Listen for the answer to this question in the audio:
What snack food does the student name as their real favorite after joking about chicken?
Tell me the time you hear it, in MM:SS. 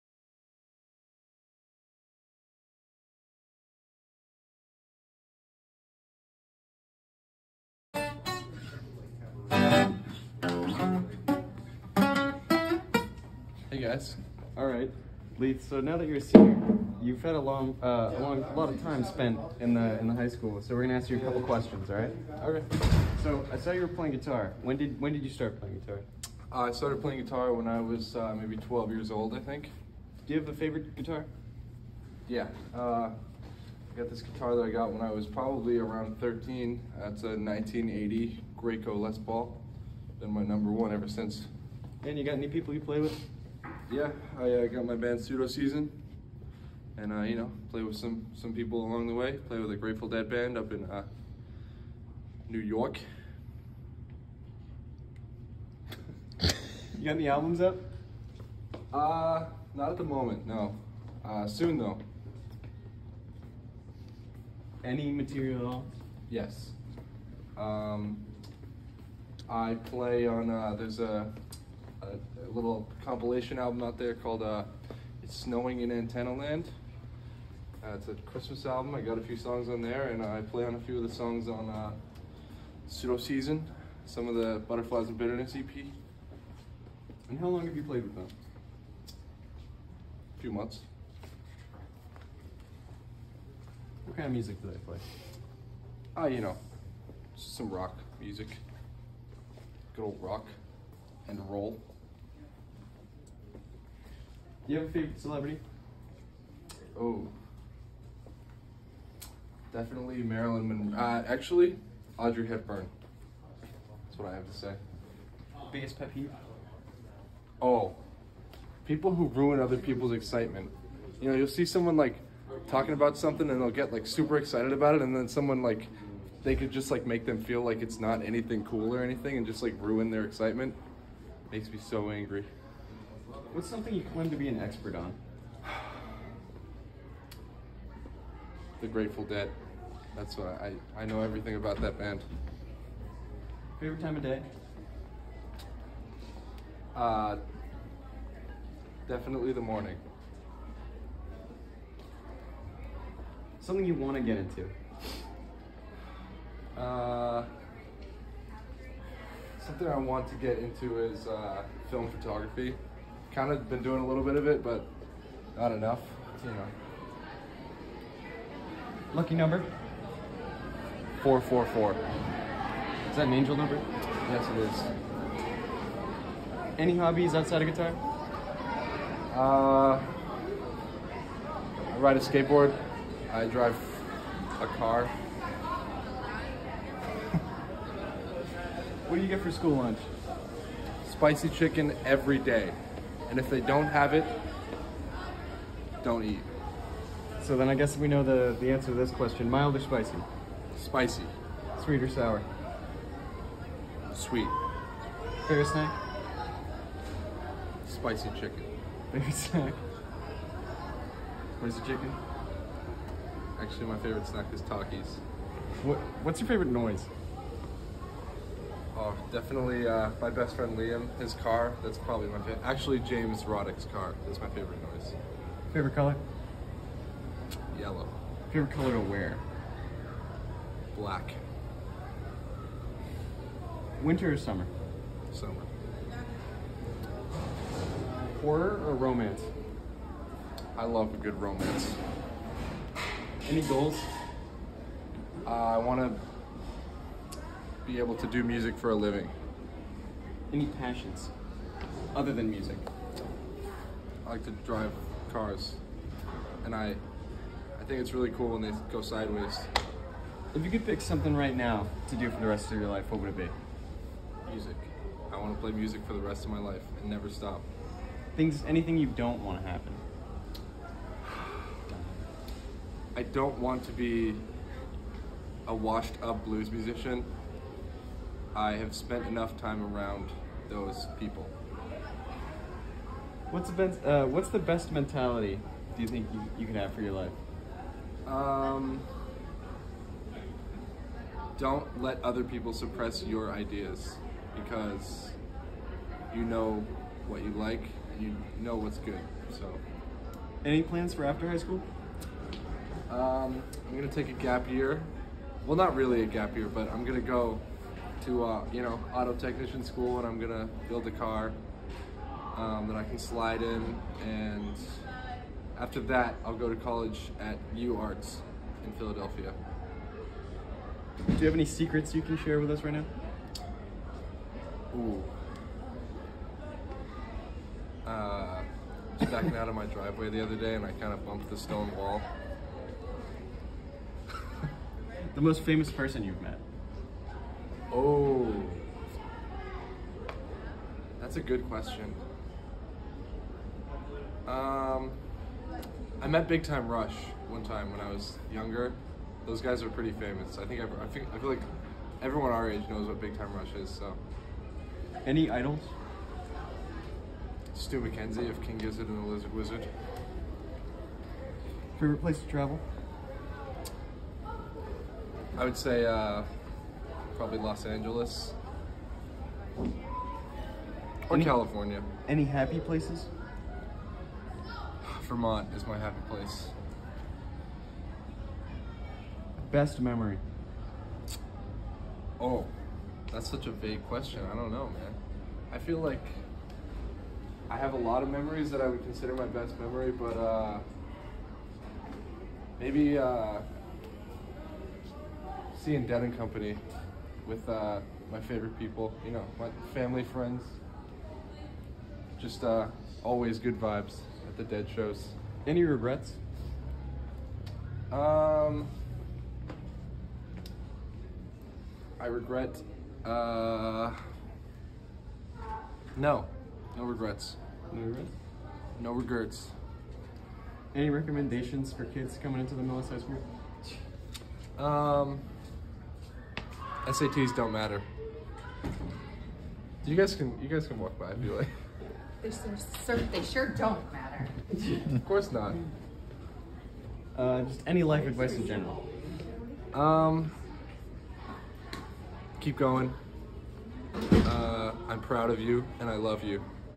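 03:34.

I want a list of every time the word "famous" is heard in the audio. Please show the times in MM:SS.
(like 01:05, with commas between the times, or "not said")
05:35, 05:50.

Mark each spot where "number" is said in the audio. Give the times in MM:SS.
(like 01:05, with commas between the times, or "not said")
00:40, 02:49, 02:53.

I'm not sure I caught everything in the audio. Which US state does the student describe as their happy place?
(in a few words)
Vermont.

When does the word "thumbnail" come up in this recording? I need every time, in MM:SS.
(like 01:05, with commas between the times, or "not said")
not said.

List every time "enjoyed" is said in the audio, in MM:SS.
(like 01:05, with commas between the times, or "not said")
not said.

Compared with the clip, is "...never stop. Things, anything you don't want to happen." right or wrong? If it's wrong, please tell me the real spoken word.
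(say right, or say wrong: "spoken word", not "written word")
right.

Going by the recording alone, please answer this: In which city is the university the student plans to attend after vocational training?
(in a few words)
Philadelphia.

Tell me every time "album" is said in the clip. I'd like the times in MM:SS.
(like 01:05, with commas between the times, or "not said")
00:57, 01:13, 01:18.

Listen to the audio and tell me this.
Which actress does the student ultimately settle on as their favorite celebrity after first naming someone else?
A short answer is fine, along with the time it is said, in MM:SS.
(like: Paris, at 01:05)
Audrey Hepburn, at 01:52.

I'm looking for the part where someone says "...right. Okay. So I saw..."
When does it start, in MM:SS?
00:21.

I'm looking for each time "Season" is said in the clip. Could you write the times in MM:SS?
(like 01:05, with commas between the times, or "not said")
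00:45, 01:23.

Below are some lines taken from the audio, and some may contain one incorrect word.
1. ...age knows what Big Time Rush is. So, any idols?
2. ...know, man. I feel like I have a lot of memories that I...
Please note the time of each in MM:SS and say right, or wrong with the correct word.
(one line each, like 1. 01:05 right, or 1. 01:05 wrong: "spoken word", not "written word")
1. 05:52 right
2. 06:24 right.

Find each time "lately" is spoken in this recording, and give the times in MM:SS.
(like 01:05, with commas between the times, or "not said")
not said.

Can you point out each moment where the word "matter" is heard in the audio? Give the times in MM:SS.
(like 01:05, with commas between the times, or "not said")
07:07, 07:14.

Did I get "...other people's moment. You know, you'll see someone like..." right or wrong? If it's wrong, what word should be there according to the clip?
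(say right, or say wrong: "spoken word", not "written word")
wrong: "excitement", not "moment".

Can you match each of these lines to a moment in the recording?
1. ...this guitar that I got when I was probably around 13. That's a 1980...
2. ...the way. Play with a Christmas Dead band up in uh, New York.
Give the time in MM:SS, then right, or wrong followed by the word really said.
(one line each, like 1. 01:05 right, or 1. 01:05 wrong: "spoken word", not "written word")
1. 00:34 right
2. 00:49 wrong: "Grateful", not "Christmas".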